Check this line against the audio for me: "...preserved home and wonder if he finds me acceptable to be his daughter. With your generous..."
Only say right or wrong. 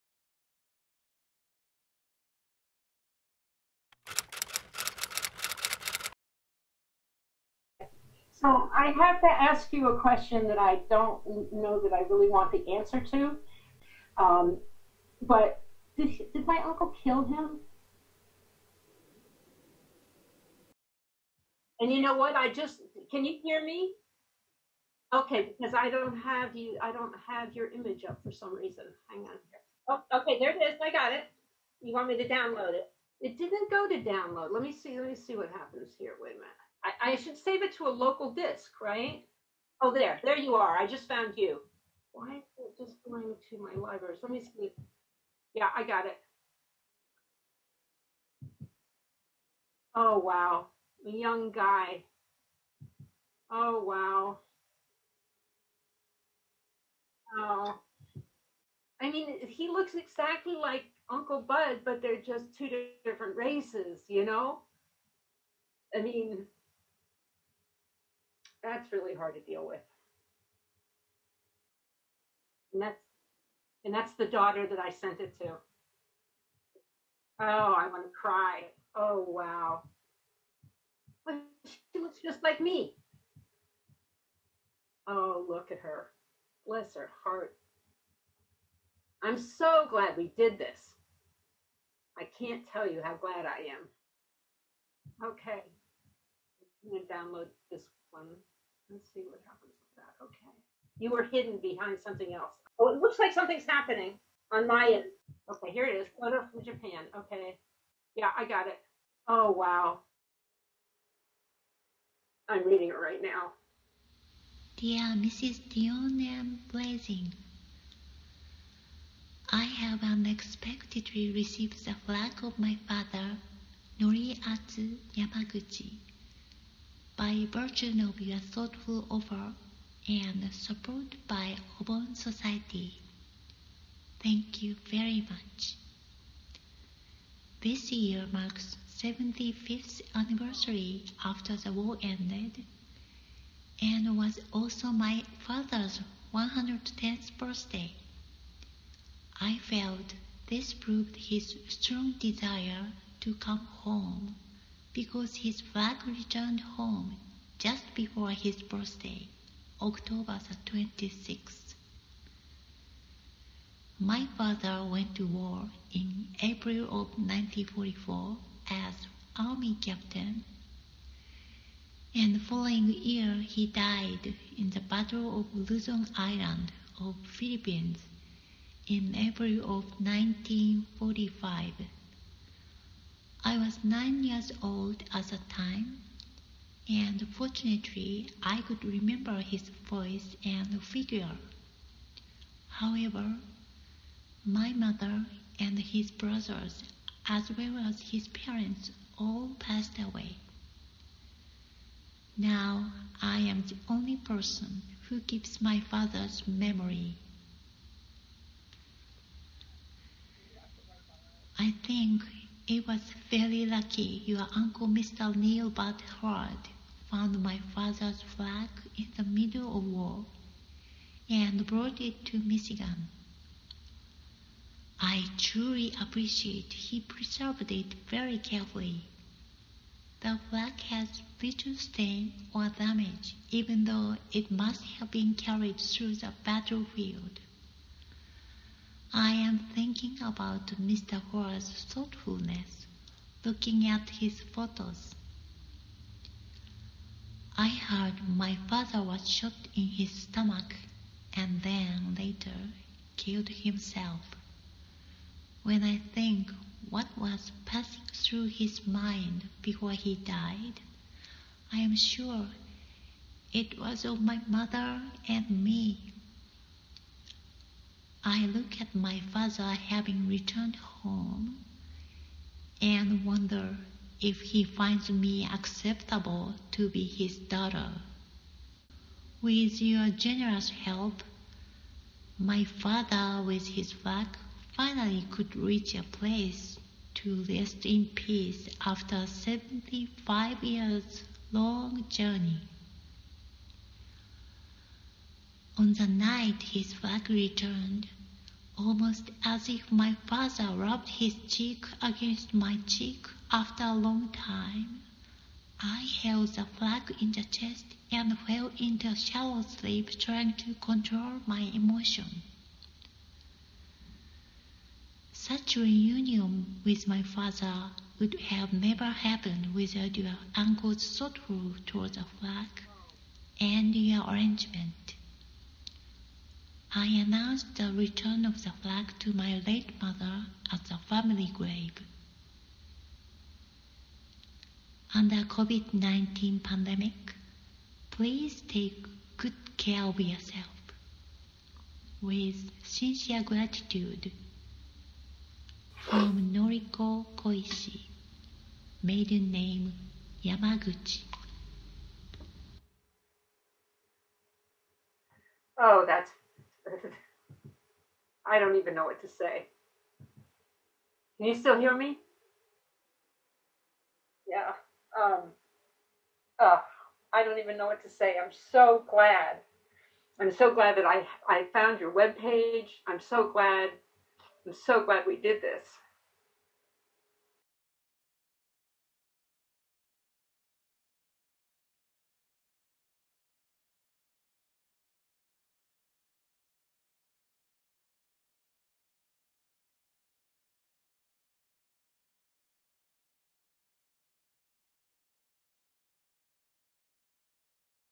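wrong.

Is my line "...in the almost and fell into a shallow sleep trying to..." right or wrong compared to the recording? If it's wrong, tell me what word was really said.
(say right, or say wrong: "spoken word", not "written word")
wrong: "chest", not "almost".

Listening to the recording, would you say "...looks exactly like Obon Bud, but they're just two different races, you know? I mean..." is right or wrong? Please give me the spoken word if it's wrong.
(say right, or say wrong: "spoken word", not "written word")
wrong: "Uncle", not "Obon".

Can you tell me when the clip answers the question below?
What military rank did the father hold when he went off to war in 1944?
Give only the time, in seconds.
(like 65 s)
169 s.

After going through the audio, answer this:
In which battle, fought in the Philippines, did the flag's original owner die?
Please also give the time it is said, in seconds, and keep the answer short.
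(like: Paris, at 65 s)
Battle of Luzon Island, at 174 s.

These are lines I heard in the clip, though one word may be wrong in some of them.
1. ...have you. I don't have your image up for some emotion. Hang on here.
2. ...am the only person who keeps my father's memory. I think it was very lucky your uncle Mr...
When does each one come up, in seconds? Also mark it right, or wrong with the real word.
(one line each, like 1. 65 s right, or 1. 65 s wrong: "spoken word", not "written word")
1. 26 s wrong: "reason", not "emotion"
2. 203 s right.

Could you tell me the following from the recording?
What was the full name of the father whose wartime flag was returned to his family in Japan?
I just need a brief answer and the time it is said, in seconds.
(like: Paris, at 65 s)
Noriatsu Yamaguchi, at 124 s.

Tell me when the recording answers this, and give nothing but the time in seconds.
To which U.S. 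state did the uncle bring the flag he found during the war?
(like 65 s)
222 s.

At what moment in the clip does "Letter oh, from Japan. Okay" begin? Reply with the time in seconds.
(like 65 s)
106 s.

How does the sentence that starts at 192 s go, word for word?
However, my mother and his brothers, as well as his parents, all passed away.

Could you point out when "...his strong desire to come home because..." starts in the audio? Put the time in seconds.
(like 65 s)
151 s.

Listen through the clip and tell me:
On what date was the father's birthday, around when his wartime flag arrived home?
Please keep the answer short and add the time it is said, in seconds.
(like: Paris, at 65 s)
October 26, at 159 s.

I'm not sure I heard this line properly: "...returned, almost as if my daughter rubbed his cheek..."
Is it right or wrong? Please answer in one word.
wrong.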